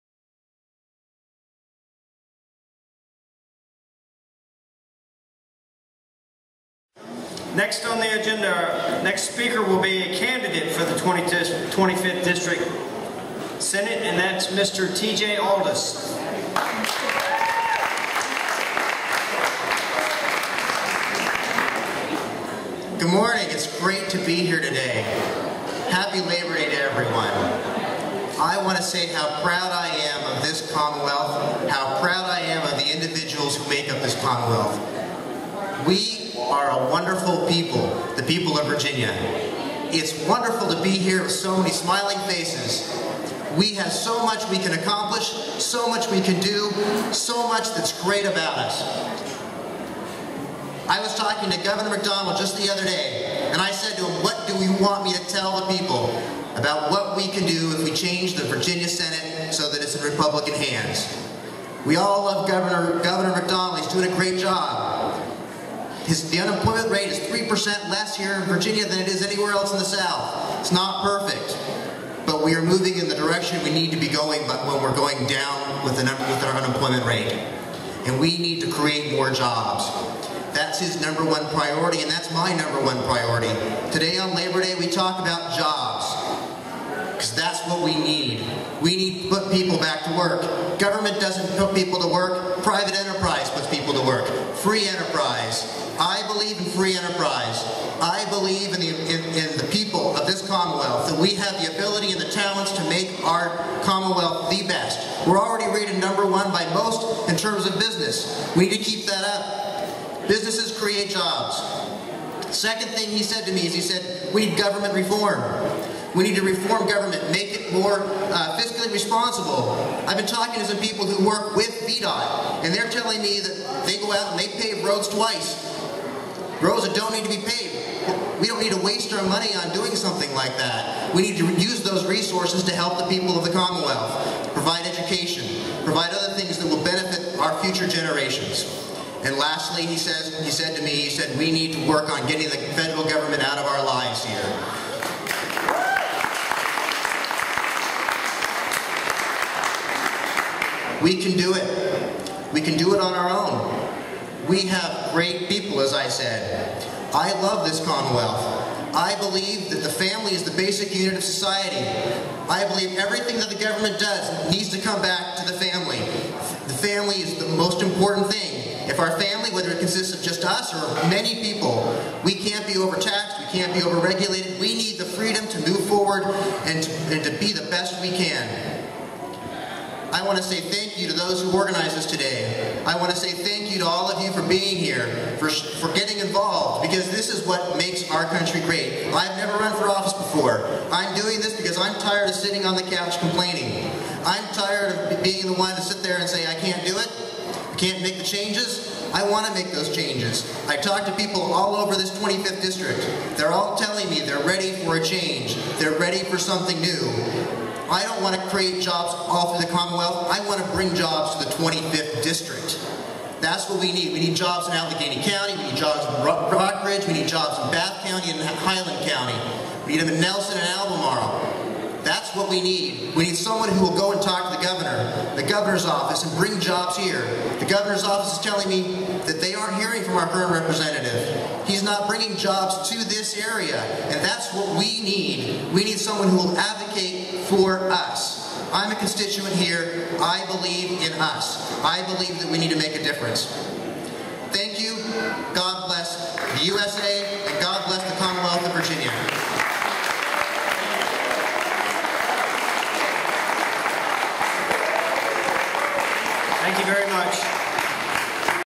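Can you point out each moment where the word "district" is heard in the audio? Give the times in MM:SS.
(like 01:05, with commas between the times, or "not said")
00:12, 03:22, 03:32.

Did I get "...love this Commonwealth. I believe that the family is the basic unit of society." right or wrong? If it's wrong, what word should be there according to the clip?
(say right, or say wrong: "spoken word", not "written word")
right.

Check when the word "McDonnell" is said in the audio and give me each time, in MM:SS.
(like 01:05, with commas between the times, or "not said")
00:51, 01:03.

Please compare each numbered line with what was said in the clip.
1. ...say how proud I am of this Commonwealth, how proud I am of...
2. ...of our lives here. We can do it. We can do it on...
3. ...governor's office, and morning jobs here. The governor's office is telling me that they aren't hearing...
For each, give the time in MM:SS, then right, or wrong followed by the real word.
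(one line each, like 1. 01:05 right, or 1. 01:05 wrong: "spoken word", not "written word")
1. 00:28 right
2. 02:23 right
3. 03:45 wrong: "bring", not "morning".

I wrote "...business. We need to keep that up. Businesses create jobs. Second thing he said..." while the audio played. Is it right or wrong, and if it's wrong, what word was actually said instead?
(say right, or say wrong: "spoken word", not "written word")
right.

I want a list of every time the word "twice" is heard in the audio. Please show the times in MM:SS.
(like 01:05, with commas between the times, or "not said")
02:05.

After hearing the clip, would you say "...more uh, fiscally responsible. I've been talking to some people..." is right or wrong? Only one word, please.
right.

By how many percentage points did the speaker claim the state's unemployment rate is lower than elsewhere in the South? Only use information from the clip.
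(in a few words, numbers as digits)
3%.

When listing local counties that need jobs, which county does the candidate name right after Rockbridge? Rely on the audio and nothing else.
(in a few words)
Bath County.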